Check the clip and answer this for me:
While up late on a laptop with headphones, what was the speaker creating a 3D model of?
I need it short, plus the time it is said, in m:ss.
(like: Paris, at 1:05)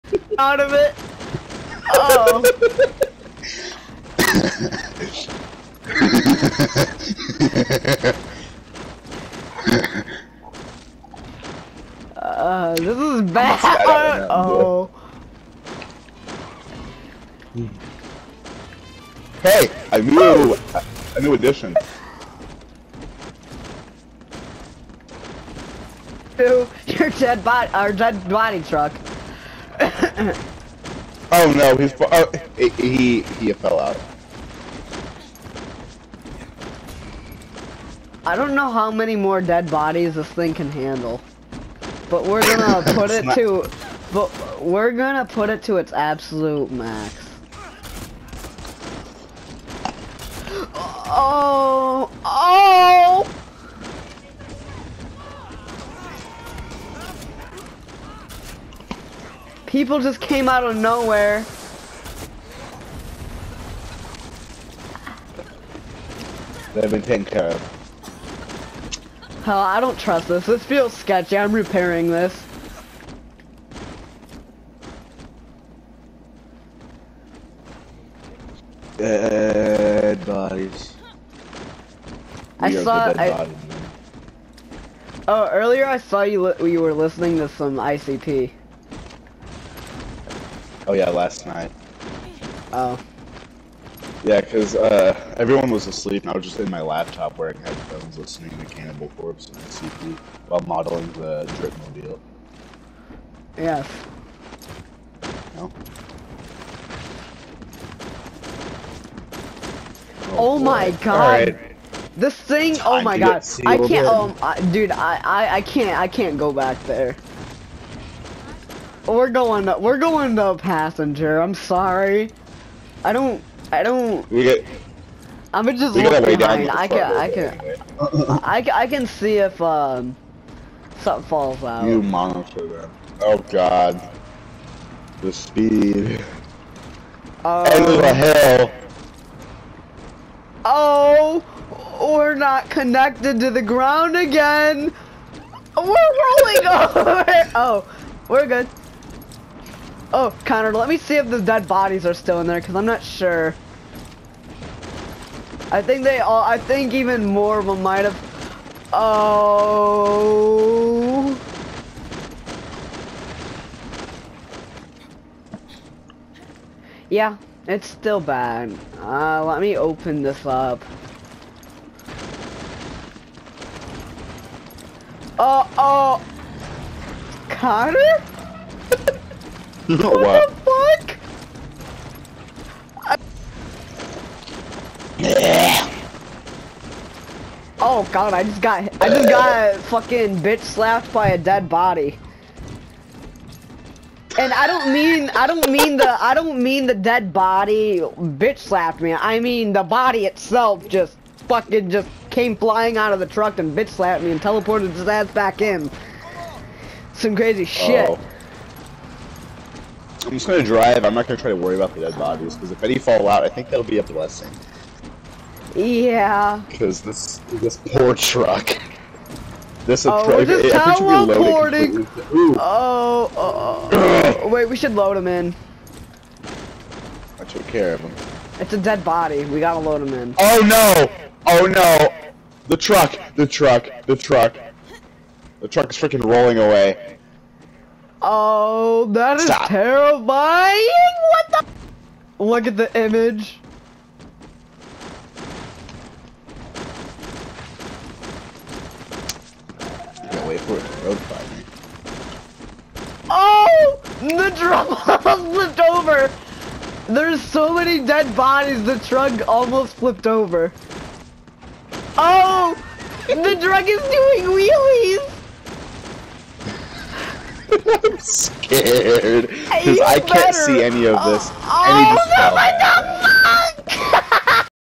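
the Dripmobile, at 1:41.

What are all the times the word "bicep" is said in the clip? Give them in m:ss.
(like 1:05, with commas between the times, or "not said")
not said.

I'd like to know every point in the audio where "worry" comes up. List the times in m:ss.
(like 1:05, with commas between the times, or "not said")
3:31.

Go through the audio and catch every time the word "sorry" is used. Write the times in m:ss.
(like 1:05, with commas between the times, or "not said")
2:01.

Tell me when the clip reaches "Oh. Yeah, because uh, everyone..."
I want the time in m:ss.
1:32.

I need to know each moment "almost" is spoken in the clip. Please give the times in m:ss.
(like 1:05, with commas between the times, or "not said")
4:19.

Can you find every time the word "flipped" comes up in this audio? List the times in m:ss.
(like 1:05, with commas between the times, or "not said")
4:15, 4:19.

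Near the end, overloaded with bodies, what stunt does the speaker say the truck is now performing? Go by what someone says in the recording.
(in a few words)
wheelies.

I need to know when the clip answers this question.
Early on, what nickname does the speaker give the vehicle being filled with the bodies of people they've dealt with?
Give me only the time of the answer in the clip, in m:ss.
0:27.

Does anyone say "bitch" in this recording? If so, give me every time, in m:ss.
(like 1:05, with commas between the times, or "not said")
3:10, 3:17, 3:23.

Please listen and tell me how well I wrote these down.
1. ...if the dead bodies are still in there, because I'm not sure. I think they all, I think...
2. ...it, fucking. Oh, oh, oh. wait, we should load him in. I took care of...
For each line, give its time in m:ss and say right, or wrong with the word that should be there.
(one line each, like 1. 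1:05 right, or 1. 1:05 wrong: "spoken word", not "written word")
1. 2:31 right
2. 3:40 wrong: "teleporting", not "fucking".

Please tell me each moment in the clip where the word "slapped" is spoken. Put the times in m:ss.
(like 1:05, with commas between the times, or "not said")
3:10, 3:18, 3:23.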